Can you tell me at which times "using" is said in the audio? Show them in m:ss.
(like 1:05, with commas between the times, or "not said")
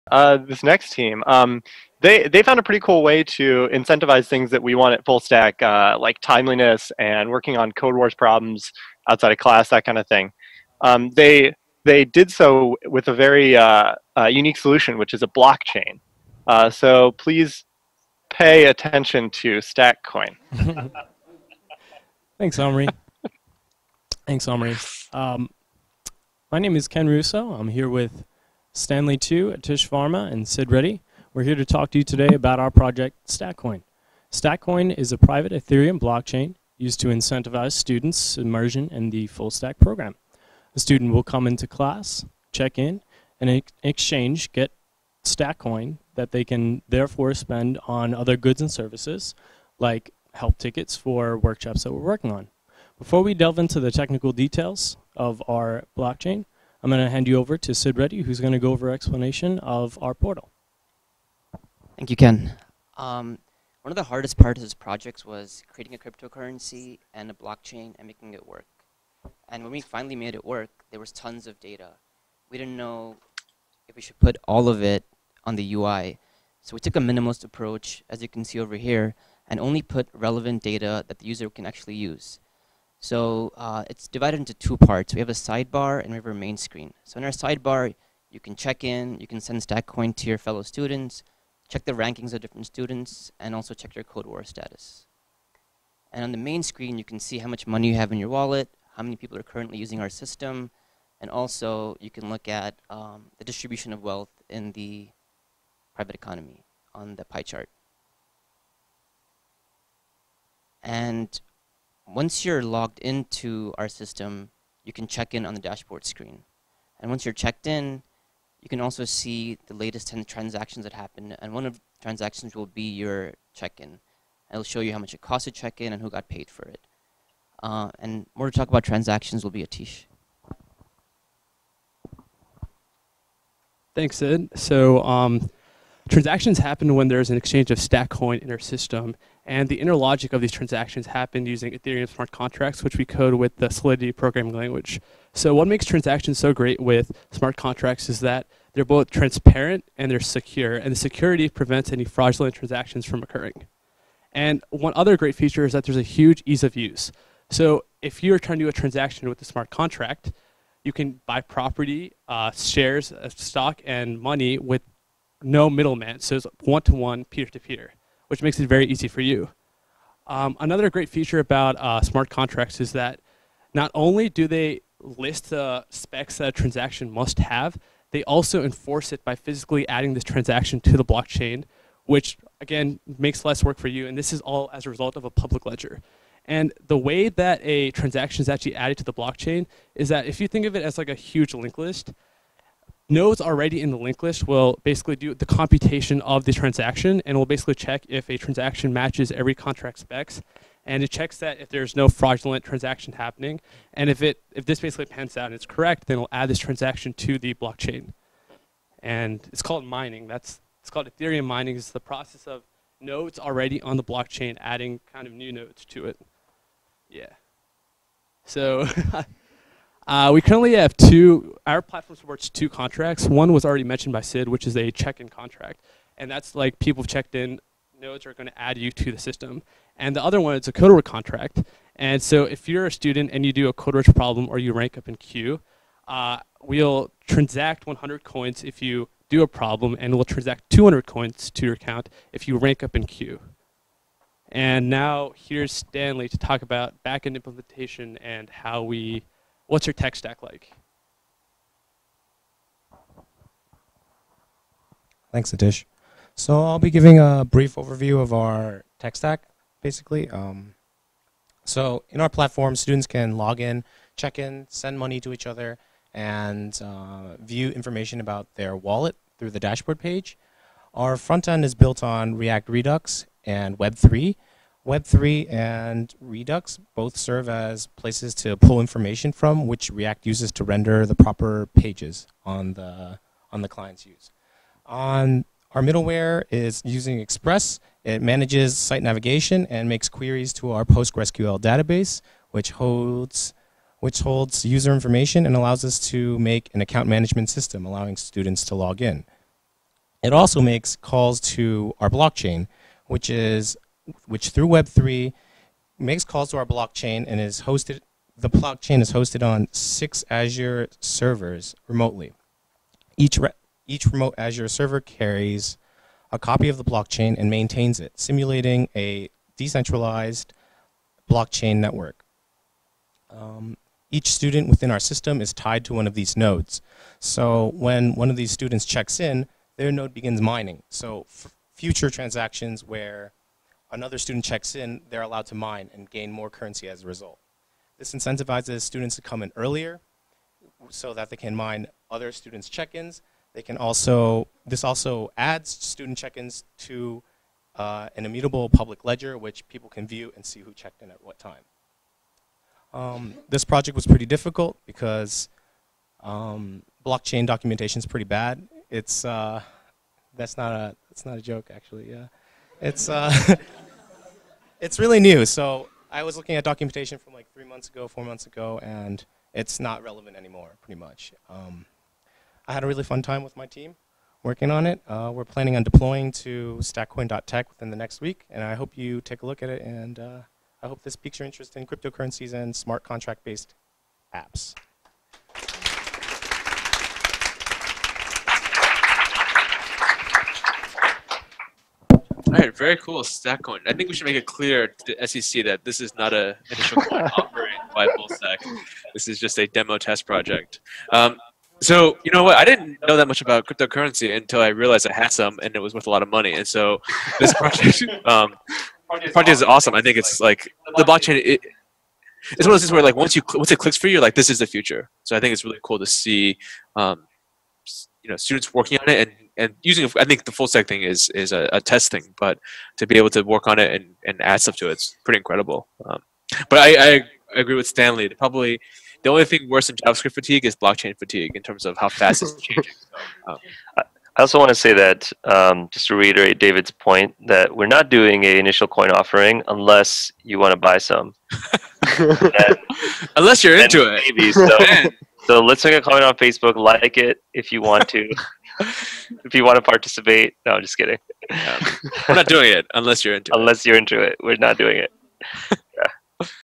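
1:39, 2:21, 4:46, 6:59.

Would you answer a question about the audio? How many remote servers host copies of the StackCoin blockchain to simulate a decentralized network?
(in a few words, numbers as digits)
6.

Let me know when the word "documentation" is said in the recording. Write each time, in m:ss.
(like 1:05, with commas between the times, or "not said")
5:57, 6:06.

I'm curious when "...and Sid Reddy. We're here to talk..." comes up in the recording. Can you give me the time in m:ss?
0:30.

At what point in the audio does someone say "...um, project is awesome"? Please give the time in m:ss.
6:48.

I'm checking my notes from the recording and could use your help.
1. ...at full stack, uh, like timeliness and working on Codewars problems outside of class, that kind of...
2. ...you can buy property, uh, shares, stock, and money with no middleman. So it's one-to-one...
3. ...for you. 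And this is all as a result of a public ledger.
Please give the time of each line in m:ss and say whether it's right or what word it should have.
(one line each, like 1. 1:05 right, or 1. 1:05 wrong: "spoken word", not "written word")
1. 0:04 right
2. 2:40 right
3. 3:03 right.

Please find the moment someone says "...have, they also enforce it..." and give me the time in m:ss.
2:57.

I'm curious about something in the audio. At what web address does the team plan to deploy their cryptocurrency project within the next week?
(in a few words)
stackcoin.tech.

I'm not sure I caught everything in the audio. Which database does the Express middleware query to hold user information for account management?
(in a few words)
PostgreSQL.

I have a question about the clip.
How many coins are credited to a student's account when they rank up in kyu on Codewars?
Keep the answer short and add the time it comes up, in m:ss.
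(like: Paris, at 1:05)
200, at 4:00.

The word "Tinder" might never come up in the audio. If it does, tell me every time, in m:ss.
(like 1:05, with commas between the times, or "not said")
not said.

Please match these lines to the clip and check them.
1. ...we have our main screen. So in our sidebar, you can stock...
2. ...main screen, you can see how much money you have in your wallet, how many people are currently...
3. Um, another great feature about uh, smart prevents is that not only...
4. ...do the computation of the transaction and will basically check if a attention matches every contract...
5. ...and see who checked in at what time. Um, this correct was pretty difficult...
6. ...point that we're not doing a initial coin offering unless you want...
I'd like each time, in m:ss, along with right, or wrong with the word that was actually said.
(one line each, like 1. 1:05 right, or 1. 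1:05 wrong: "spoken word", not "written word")
1. 1:26 wrong: "check", not "stock"
2. 1:36 right
3. 2:50 wrong: "contracts", not "prevents"
4. 3:15 wrong: "transaction", not "attention"
5. 5:50 wrong: "project", not "correct"
6. 7:16 right.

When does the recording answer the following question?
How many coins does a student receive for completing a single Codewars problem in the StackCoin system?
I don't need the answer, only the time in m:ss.
3:57.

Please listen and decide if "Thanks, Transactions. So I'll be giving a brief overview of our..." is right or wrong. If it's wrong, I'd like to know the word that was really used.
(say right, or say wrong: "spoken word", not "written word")
wrong: "Aatish", not "Transactions".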